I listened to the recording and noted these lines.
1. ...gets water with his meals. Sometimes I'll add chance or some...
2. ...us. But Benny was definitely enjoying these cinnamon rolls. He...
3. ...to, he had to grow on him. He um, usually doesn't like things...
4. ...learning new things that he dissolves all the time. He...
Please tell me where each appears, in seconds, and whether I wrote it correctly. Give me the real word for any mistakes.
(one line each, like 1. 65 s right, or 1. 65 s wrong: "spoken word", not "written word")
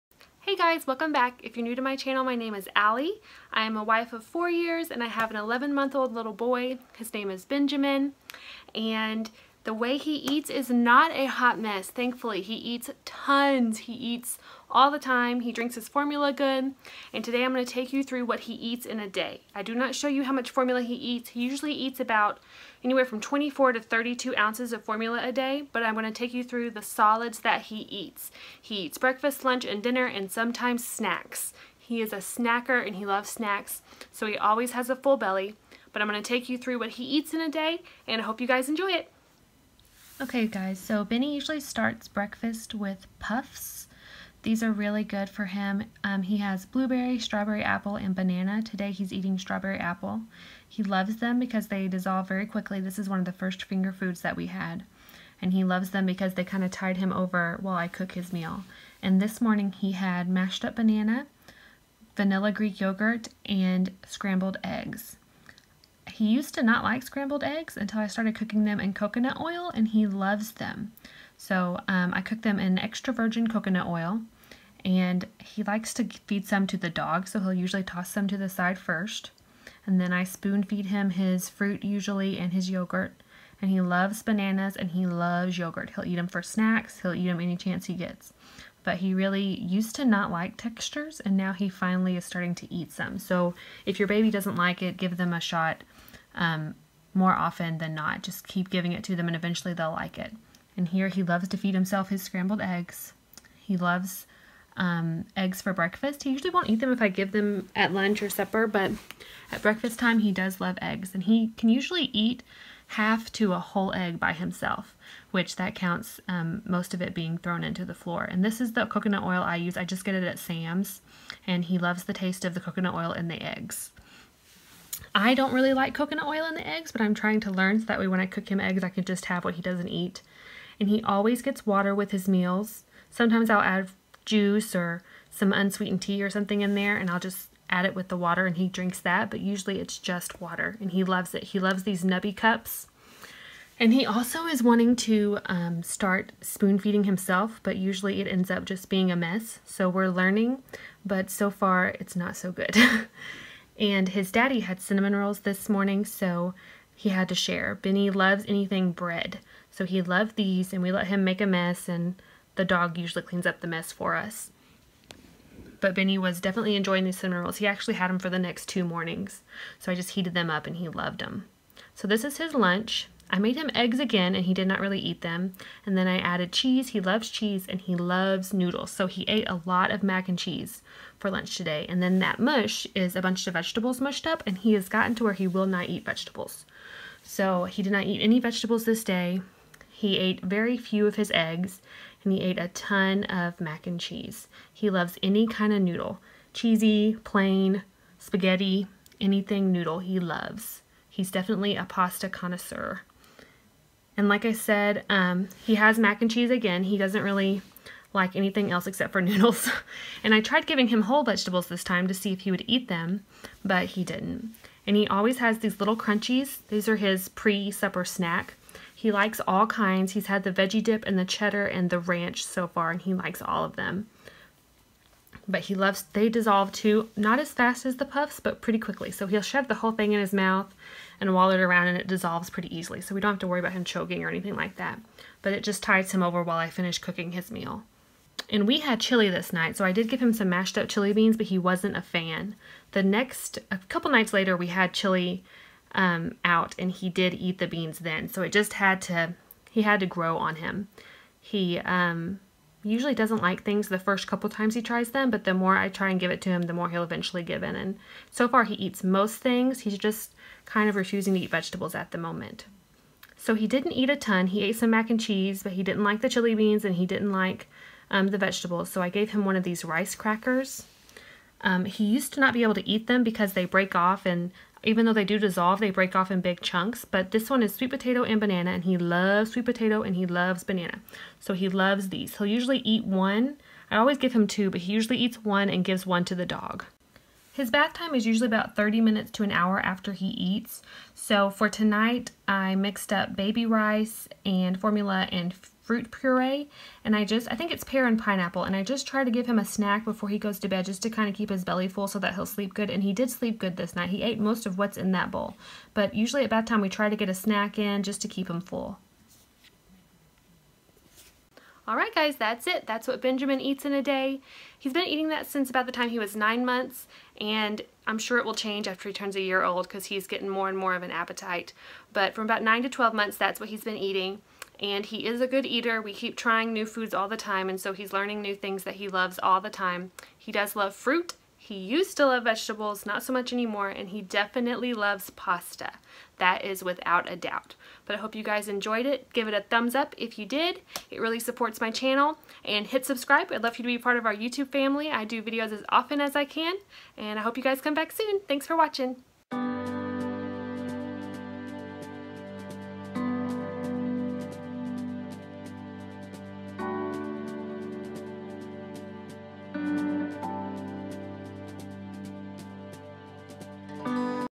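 1. 131 s wrong: "juice", not "chance"
2. 164 s right
3. 249 s right
4. 328 s wrong: "loves", not "dissolves".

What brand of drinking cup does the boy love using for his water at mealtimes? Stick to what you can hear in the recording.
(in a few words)
Nuby.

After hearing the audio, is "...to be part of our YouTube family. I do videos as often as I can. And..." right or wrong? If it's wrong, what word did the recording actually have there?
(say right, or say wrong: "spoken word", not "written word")
right.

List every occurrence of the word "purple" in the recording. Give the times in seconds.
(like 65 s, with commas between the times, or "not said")
not said.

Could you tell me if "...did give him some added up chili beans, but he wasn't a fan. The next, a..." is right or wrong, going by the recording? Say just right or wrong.
wrong.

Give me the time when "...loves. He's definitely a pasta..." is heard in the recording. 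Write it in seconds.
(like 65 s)
200 s.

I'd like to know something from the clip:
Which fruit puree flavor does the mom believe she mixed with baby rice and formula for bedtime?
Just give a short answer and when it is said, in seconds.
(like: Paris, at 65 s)
pear and pineapple, at 297 s.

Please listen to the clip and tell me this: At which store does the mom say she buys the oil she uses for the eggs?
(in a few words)
Sam's.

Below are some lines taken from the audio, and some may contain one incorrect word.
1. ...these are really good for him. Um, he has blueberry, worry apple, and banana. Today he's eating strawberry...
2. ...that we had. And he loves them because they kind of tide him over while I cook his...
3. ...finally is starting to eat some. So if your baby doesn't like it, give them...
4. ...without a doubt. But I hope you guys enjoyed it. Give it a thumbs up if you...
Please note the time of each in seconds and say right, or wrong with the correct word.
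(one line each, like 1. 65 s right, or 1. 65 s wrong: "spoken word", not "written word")
1. 44 s wrong: "strawberry", not "worry"
2. 54 s right
3. 91 s right
4. 336 s right.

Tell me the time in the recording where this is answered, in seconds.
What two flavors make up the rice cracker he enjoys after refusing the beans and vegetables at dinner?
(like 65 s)
277 s.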